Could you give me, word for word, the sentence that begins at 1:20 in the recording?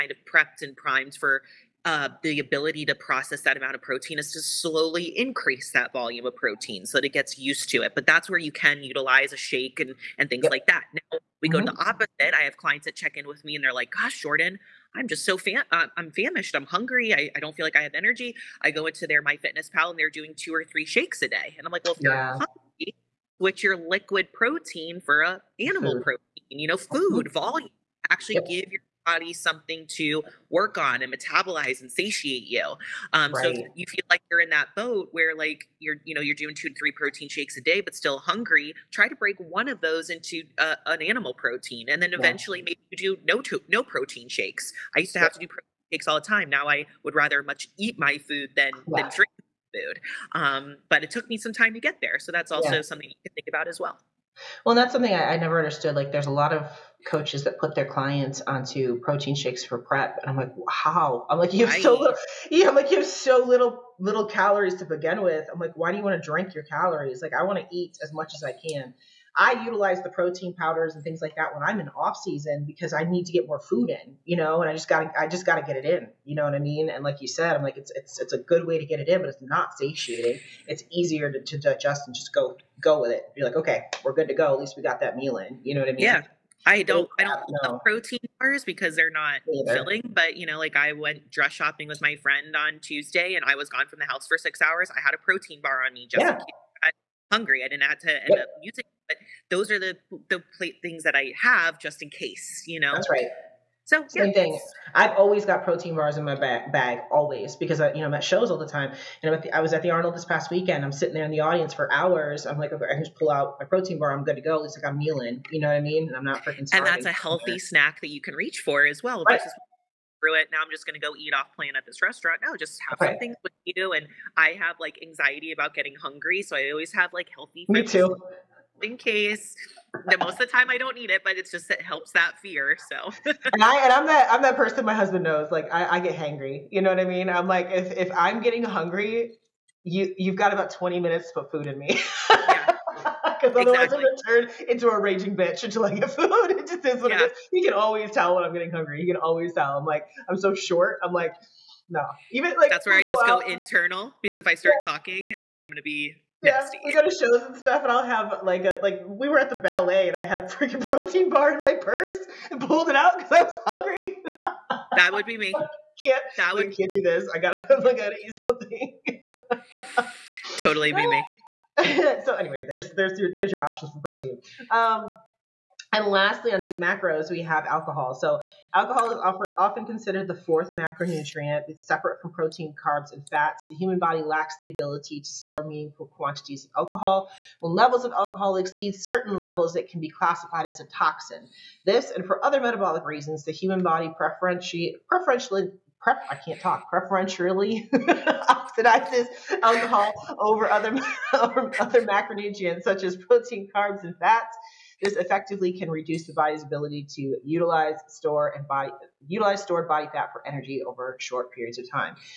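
It's easier to, to digest and just go go with it.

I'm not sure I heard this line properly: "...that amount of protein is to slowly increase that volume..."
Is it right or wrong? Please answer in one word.
right.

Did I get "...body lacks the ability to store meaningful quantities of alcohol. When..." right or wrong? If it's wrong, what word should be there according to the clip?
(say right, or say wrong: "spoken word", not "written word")
right.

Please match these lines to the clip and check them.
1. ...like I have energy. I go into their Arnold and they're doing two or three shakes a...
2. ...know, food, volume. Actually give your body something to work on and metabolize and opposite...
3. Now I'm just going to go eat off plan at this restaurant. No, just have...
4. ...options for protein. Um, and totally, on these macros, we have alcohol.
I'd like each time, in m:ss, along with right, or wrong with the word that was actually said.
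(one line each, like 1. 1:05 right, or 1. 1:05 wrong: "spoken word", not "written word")
1. 0:17 wrong: "MyFitnessPal", not "Arnold"
2. 0:26 wrong: "satiate", not "opposite"
3. 2:00 right
4. 2:53 wrong: "lastly", not "totally".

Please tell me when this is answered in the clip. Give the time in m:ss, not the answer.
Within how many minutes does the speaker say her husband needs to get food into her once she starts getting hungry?
2:20.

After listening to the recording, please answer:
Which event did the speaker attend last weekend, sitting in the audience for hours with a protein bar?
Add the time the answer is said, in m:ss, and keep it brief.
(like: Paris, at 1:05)
The Arnold, at 1:49.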